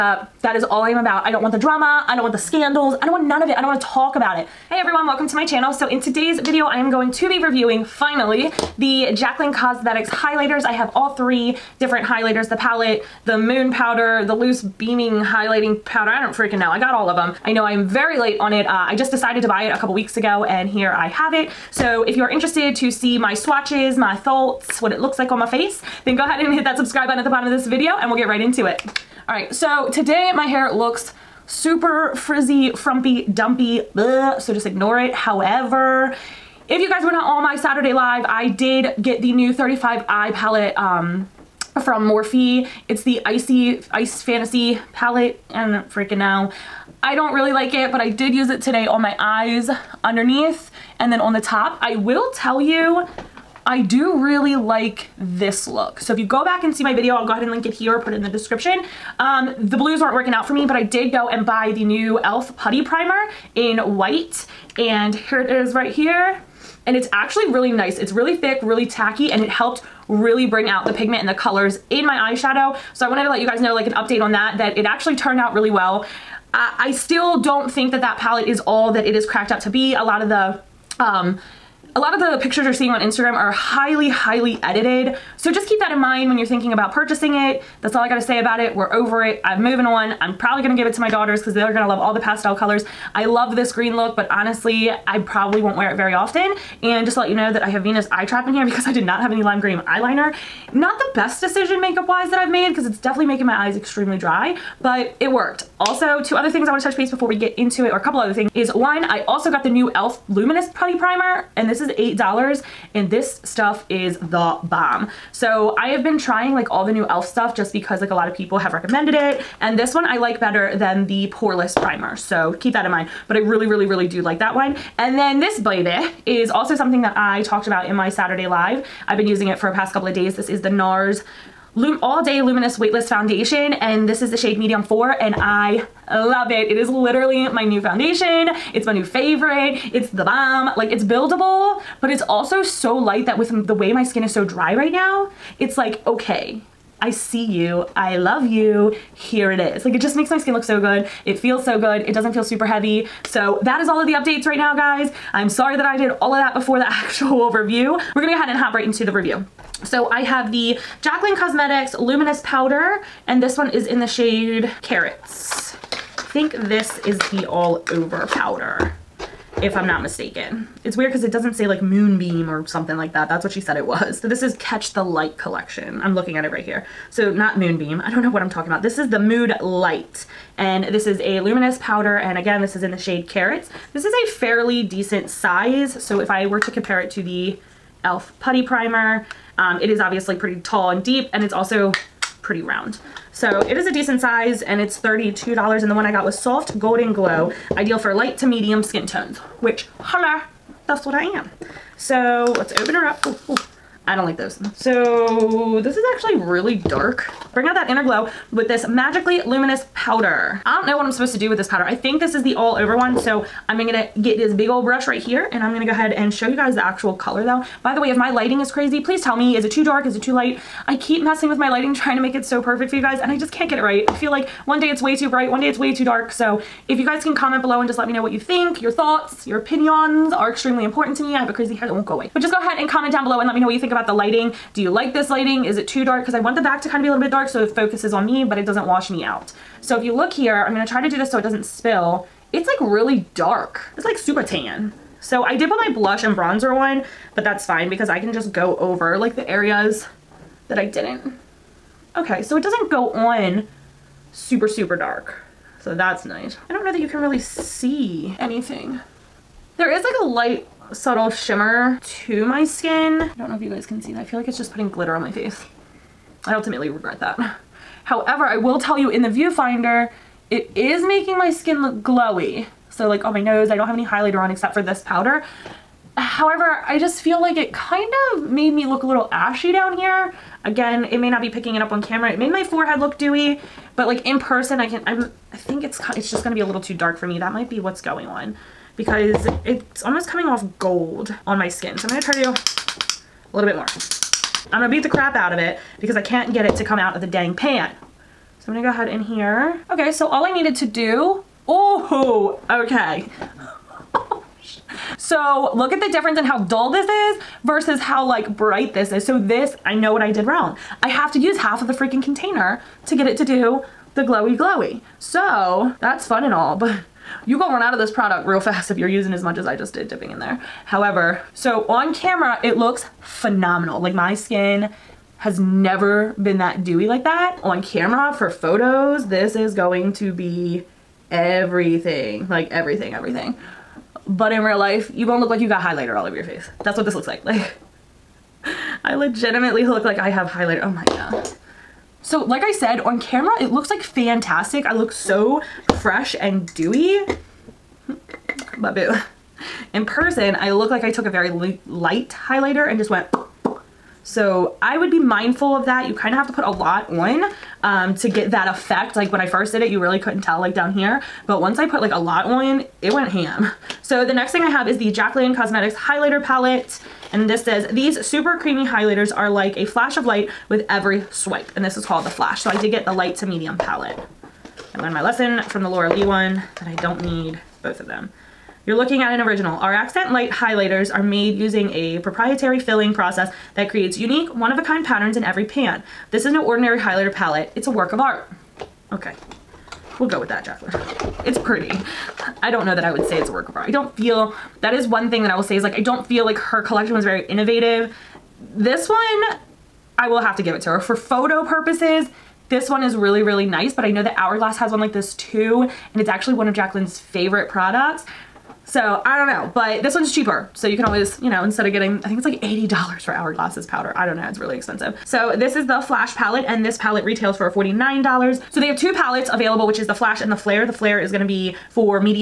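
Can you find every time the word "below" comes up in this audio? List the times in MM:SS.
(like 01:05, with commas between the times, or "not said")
03:47, 03:53.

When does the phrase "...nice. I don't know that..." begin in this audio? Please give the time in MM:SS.
04:16.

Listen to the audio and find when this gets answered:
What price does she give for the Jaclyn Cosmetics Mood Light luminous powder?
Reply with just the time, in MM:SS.
03:14.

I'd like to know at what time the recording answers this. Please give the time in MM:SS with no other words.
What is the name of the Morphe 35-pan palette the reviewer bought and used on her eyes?
00:43.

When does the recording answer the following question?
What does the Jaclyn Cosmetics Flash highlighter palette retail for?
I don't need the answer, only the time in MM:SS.
06:57.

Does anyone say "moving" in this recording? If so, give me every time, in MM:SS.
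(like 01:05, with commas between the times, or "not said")
01:29.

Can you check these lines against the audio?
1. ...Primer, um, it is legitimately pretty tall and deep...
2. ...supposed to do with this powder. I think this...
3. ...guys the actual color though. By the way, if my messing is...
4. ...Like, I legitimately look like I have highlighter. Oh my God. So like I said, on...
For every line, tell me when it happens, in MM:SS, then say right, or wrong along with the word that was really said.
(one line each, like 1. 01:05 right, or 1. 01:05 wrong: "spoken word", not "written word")
1. 03:08 wrong: "obviously", not "legitimately"
2. 03:31 right
3. 03:36 wrong: "lighting", not "messing"
4. 05:38 right.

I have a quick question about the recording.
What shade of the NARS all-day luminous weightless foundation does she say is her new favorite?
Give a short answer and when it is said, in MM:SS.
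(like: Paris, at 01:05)
medium 4, at 02:14.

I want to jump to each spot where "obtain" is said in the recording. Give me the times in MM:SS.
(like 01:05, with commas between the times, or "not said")
not said.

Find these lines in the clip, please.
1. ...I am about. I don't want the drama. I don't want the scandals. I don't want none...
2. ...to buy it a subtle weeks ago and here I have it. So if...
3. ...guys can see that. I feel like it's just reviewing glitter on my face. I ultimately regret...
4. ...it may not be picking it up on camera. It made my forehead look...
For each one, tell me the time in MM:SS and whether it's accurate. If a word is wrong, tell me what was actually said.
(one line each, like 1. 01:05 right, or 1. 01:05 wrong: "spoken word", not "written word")
1. 00:00 right
2. 00:19 wrong: "couple", not "subtle"
3. 04:23 wrong: "putting", not "reviewing"
4. 04:41 right.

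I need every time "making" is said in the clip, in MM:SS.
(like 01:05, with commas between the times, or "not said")
01:43, 04:31.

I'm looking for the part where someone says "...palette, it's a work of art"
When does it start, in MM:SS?
06:27.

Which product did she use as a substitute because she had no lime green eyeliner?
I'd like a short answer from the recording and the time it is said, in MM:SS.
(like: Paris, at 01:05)
Venus Eye Trap, at 01:37.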